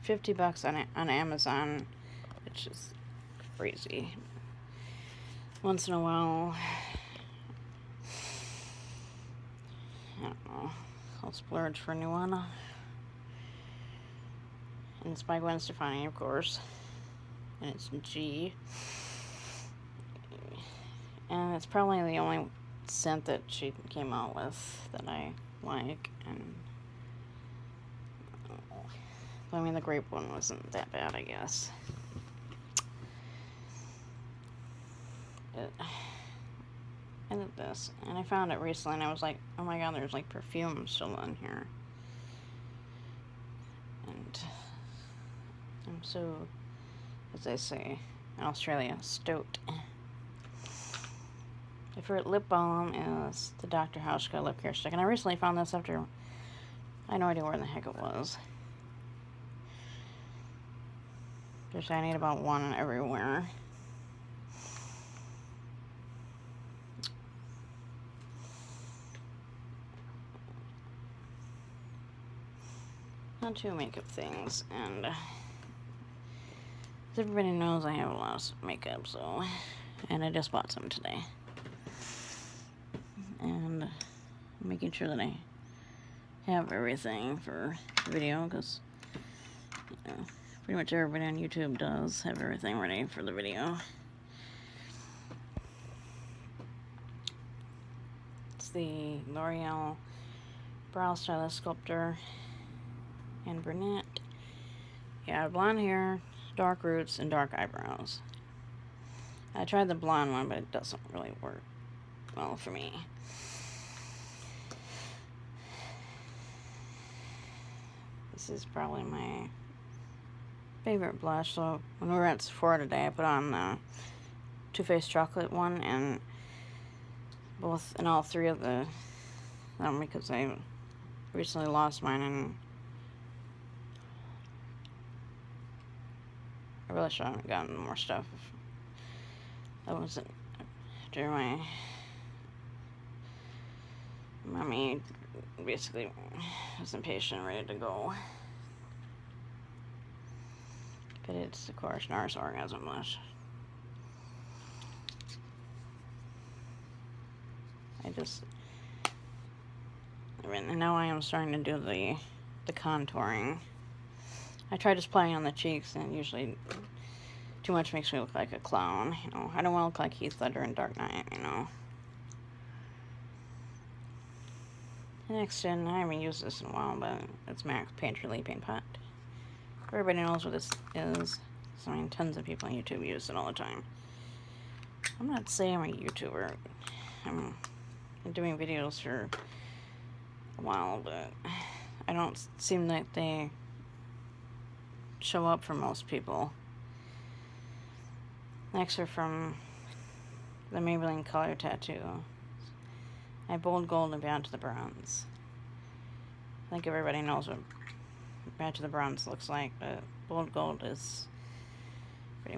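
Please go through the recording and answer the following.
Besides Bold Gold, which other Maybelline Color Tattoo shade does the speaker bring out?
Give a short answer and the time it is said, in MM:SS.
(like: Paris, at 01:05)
Bad to the Bronze, at 03:24.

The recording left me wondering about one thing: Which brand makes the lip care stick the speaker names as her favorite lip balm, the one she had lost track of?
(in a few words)
Dr. Hauschka.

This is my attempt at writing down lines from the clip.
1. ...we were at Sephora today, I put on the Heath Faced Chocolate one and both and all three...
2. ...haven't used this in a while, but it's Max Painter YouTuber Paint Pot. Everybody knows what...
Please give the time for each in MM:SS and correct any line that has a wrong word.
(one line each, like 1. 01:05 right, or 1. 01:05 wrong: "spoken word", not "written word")
1. 02:02 wrong: "Too", not "Heath"
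2. 02:55 wrong: "Leaping", not "YouTuber".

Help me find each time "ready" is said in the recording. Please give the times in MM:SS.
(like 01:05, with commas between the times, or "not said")
01:32, 02:27.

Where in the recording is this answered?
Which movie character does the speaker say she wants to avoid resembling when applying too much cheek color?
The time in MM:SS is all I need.
02:50.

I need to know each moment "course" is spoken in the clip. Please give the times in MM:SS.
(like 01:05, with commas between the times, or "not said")
00:16, 02:31.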